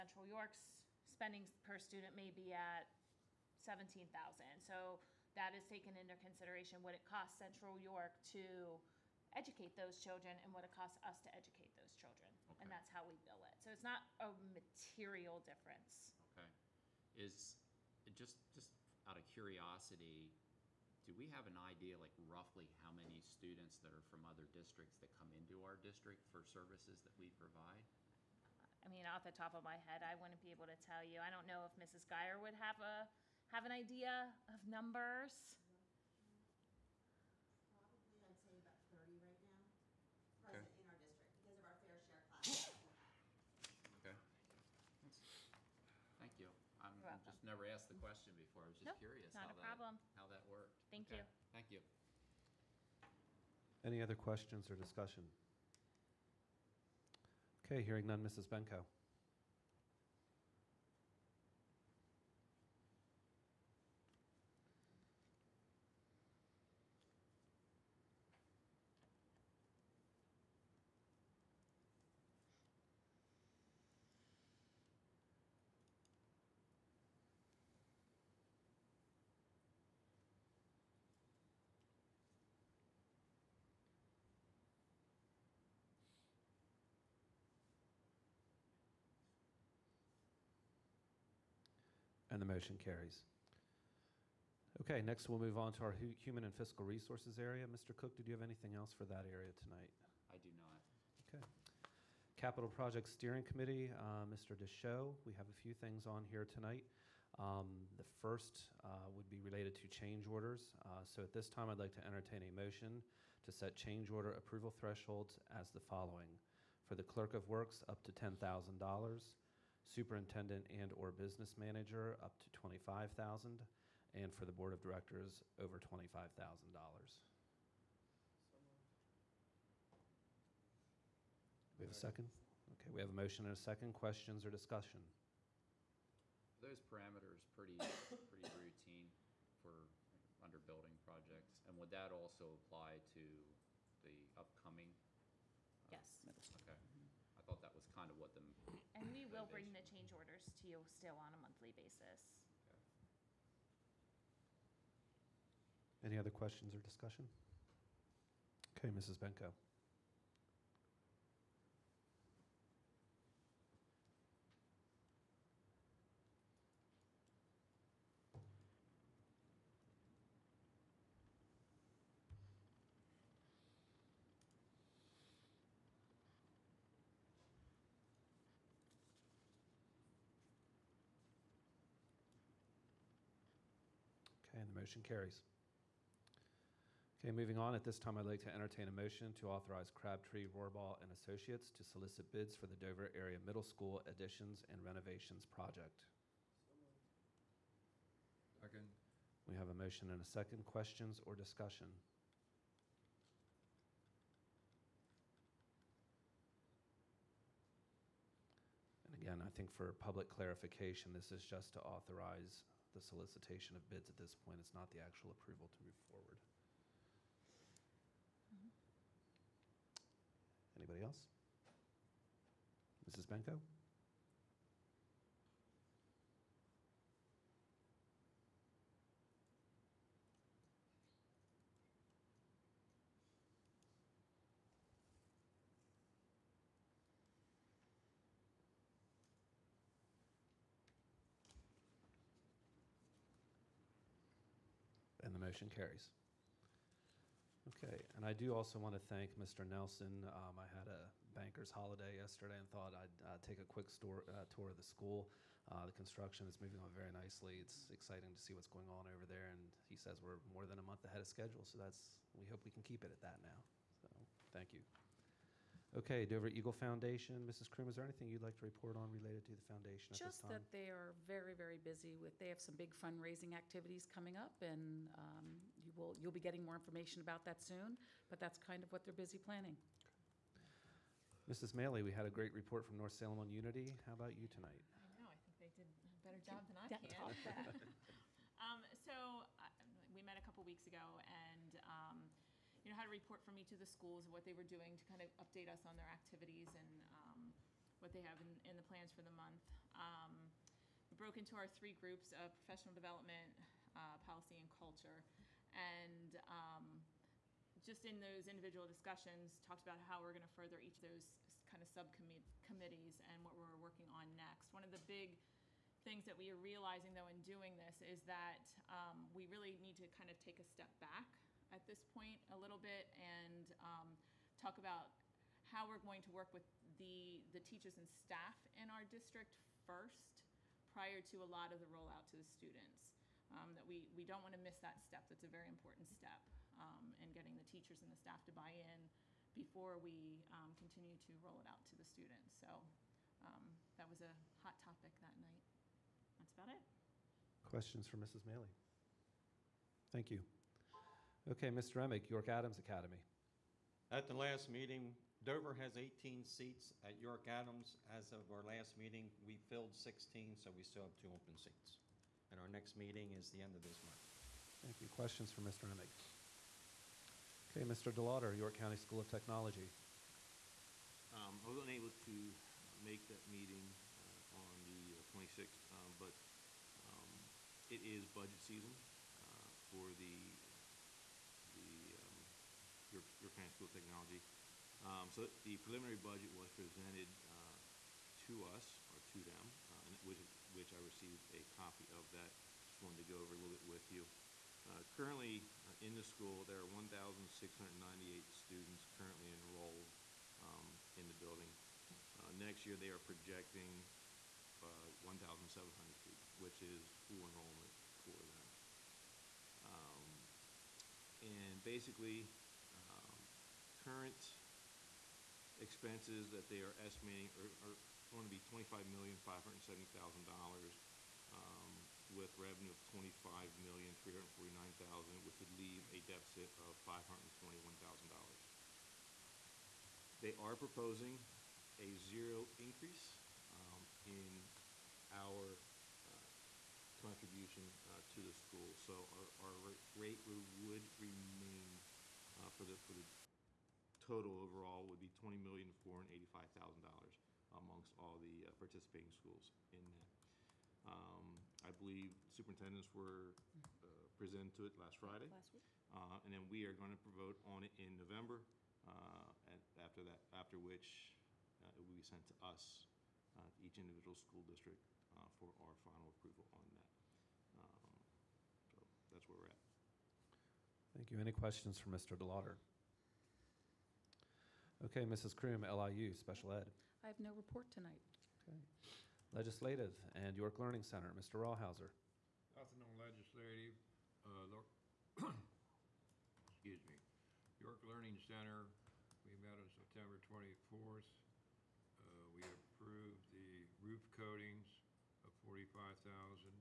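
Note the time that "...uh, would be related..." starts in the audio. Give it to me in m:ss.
1:48.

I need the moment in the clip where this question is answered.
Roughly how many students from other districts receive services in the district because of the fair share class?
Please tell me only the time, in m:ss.
0:38.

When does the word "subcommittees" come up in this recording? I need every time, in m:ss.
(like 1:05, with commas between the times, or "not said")
5:11.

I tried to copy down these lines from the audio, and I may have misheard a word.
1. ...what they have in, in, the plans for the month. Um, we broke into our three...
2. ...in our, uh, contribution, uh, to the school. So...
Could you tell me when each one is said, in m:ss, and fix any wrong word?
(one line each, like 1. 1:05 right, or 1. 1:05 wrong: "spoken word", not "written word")
1. 4:58 right
2. 7:14 right.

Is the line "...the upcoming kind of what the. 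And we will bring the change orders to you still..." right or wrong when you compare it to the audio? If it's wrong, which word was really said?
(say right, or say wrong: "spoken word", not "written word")
right.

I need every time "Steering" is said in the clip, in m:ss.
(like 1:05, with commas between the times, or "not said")
1:43.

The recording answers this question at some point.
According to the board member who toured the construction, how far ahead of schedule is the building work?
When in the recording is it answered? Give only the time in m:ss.
4:20.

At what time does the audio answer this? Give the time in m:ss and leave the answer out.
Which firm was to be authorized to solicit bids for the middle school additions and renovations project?
3:09.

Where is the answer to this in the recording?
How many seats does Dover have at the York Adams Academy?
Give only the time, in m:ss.
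5:55.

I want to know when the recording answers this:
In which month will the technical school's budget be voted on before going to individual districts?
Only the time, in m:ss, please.
7:38.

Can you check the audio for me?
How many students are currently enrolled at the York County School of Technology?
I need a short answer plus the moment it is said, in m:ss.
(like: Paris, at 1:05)
1,698, at 6:36.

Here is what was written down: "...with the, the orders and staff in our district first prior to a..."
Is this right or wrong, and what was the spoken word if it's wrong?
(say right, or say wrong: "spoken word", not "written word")
wrong: "teachers", not "orders".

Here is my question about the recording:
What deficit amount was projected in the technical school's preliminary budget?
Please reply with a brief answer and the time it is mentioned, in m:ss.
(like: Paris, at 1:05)
$521,000, at 7:07.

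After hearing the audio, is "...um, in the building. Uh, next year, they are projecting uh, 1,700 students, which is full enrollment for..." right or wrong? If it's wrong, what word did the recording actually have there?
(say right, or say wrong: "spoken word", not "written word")
right.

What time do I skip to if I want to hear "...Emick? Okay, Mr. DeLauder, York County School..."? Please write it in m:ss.
6:05.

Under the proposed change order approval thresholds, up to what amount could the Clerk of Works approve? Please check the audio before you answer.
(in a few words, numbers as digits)
$10,000.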